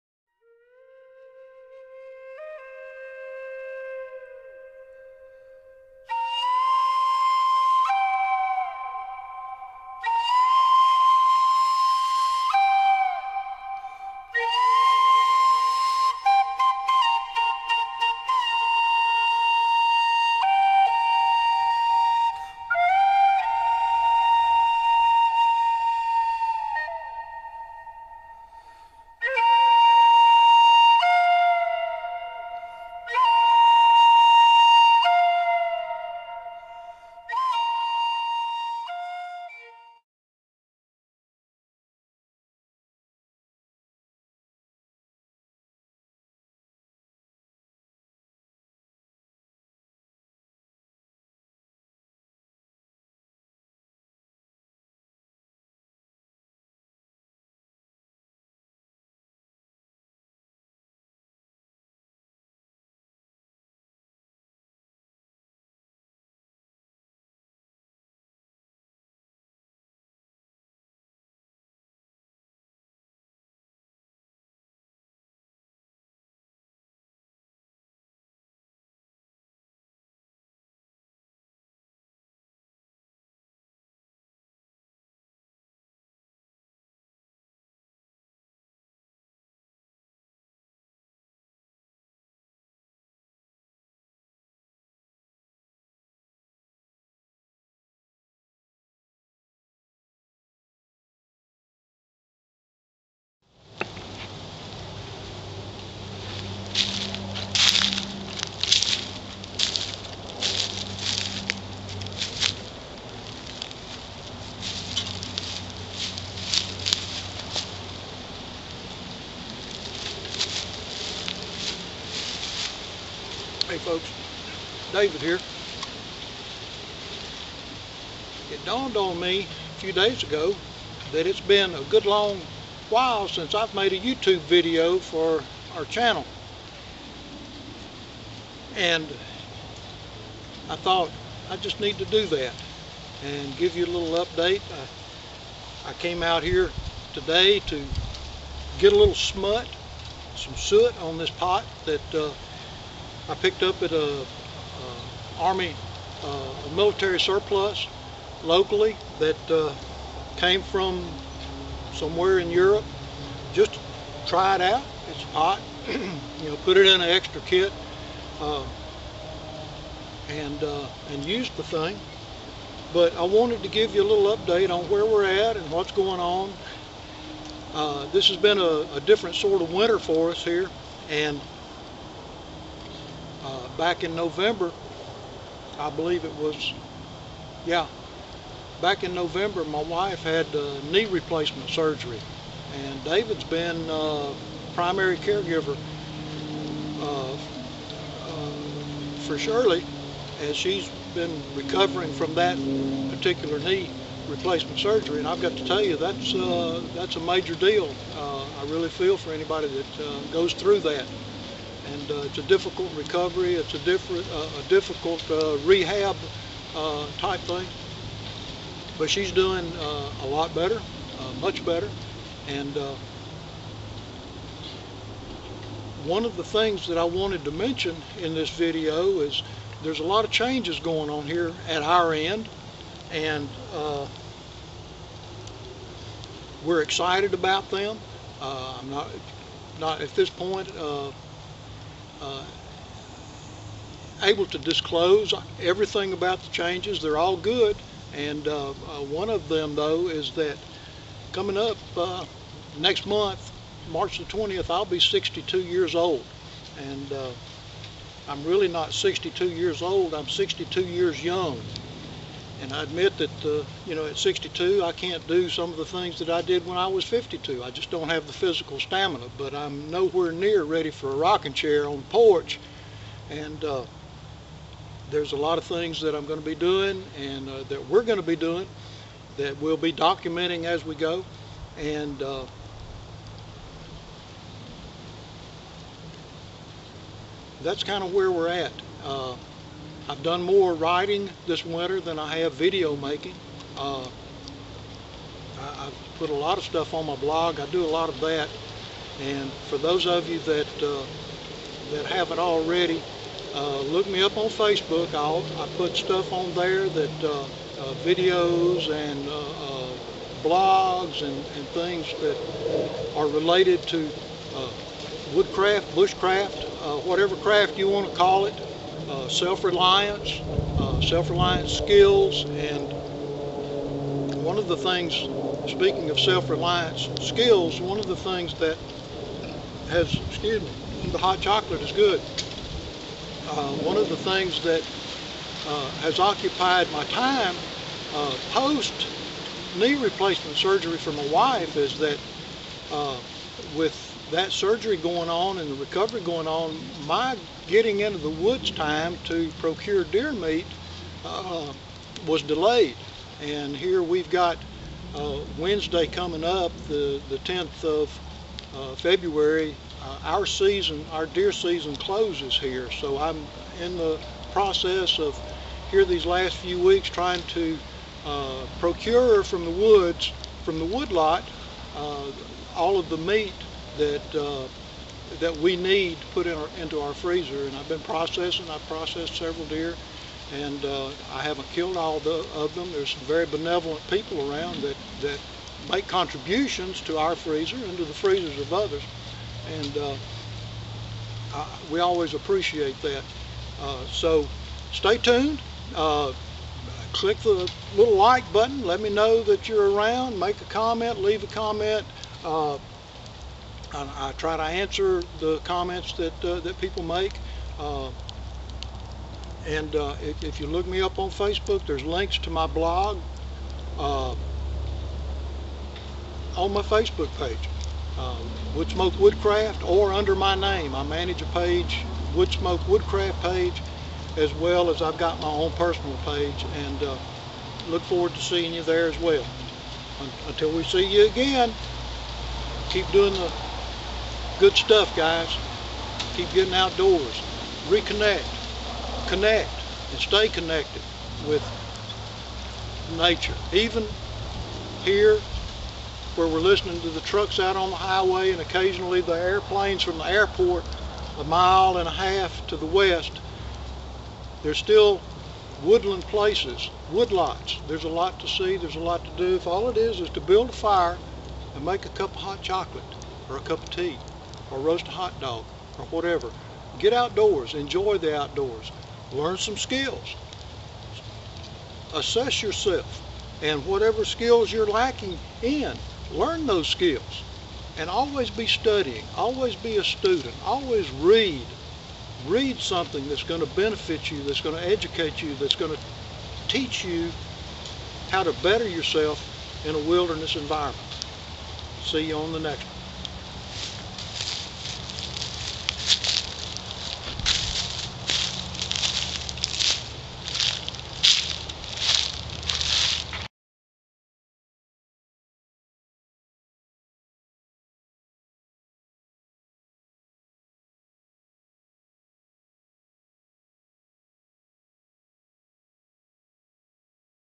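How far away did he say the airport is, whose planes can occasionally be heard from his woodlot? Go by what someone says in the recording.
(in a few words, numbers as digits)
1.5 miles.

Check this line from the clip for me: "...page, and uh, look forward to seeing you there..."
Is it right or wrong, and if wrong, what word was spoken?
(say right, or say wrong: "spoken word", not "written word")
right.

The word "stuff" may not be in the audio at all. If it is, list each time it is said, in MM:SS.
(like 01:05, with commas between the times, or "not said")
04:56, 05:05, 07:14.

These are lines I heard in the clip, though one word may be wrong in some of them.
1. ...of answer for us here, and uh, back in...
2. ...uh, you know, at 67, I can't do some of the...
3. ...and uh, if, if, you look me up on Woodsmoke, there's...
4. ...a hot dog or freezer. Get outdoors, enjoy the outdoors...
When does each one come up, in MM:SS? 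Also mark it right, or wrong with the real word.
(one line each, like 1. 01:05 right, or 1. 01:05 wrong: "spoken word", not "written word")
1. 02:59 wrong: "winter", not "answer"
2. 04:23 wrong: "62", not "67"
3. 06:49 wrong: "Facebook", not "Woodsmoke"
4. 07:45 wrong: "whatever", not "freezer".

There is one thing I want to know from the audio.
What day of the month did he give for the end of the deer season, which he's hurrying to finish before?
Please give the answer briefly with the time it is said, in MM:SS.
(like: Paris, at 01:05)
10th, at 05:57.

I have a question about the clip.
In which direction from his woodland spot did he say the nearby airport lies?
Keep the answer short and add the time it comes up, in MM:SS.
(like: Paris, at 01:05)
west, at 07:32.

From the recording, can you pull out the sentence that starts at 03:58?
Uh, I'm not, not at this point, uh, uh, able to disclose everything about the changes.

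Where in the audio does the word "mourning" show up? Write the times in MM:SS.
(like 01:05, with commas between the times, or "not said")
not said.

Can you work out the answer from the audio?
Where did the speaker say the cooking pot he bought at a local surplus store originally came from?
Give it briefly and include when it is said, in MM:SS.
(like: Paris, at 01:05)
Europe, at 02:42.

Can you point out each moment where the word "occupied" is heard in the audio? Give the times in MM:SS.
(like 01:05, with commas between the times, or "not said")
05:36.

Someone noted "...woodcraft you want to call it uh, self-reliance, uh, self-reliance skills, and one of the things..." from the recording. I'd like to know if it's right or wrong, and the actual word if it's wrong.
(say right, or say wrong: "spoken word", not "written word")
wrong: "craft", not "woodcraft".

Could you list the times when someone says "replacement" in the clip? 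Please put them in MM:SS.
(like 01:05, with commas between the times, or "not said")
03:11, 03:24, 05:40.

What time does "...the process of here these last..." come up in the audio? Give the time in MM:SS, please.
06:03.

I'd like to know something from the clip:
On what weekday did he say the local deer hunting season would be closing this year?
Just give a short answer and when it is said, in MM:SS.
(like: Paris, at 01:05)
Wednesday, at 05:55.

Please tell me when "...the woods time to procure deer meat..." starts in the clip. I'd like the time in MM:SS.
05:48.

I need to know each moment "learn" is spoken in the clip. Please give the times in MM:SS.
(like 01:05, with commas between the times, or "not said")
07:49, 07:56.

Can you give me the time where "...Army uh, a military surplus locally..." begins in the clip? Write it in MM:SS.
02:35.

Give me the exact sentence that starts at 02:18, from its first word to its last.
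And I thought I just need to do that and give you a little update.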